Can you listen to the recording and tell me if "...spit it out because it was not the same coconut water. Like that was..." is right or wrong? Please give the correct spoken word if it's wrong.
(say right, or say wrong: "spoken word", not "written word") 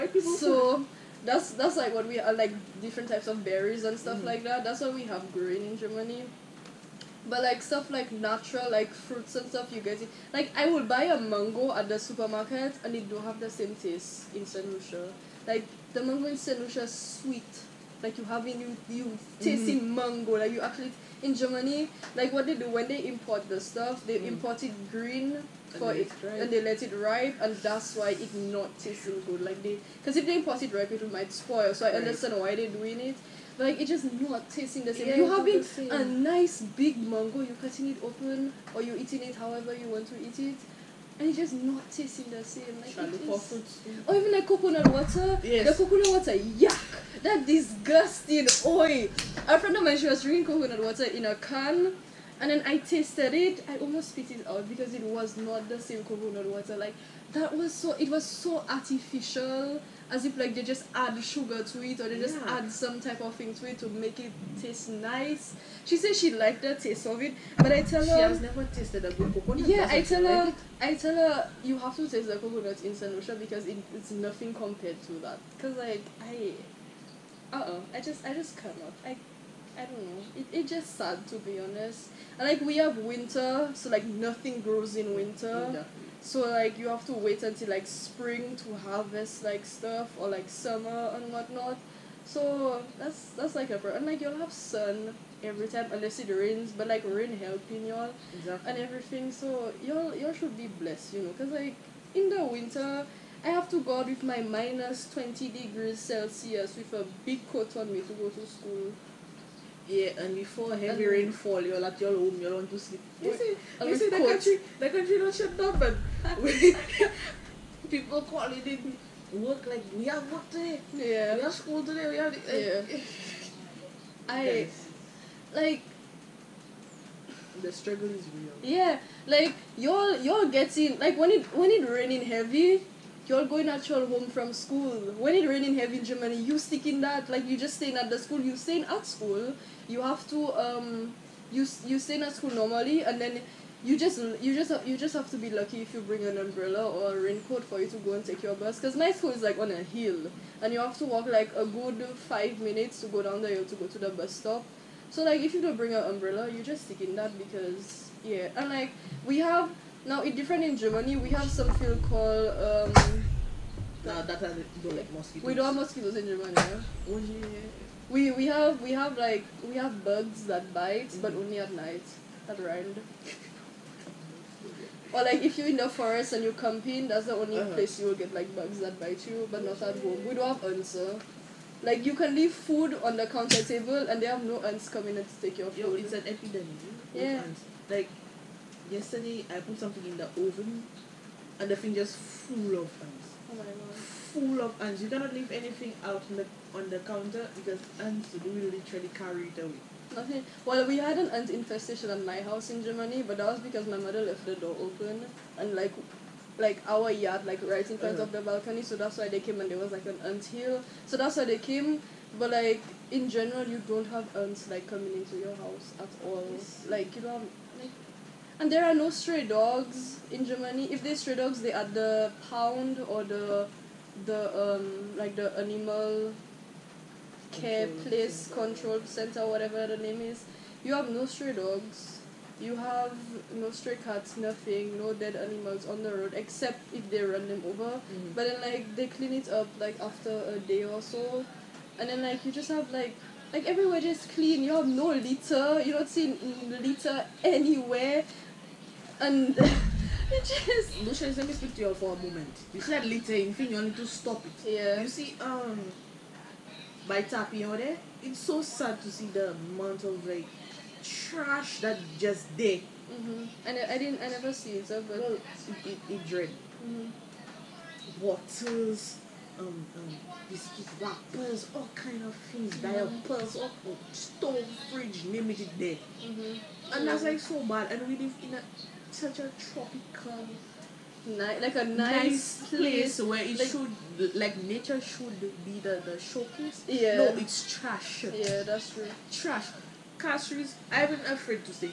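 right.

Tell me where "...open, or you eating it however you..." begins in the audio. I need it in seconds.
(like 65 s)
38 s.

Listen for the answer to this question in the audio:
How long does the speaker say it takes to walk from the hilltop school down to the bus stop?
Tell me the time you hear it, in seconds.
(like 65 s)
152 s.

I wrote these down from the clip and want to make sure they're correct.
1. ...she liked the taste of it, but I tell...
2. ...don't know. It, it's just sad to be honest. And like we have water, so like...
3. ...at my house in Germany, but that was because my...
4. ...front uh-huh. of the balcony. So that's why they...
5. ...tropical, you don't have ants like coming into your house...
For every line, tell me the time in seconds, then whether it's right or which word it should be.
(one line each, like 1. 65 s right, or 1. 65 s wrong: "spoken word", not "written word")
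1. 66 s right
2. 79 s wrong: "winter", not "water"
3. 202 s right
4. 207 s right
5. 213 s wrong: "general", not "tropical".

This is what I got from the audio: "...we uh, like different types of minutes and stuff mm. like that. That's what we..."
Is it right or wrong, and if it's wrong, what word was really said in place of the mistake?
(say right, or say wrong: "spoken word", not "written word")
wrong: "berries", not "minutes".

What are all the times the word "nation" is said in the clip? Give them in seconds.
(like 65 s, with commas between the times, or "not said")
not said.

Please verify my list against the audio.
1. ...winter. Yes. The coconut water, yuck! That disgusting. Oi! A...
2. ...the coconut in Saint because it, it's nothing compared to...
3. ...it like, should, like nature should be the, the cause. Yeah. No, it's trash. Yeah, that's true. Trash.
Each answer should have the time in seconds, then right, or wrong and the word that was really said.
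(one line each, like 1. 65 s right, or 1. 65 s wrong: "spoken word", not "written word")
1. 44 s wrong: "water", not "winter"
2. 72 s right
3. 283 s wrong: "showcase", not "cause".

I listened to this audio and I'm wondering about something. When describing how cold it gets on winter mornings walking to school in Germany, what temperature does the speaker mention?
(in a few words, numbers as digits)
-20 degrees Celsius.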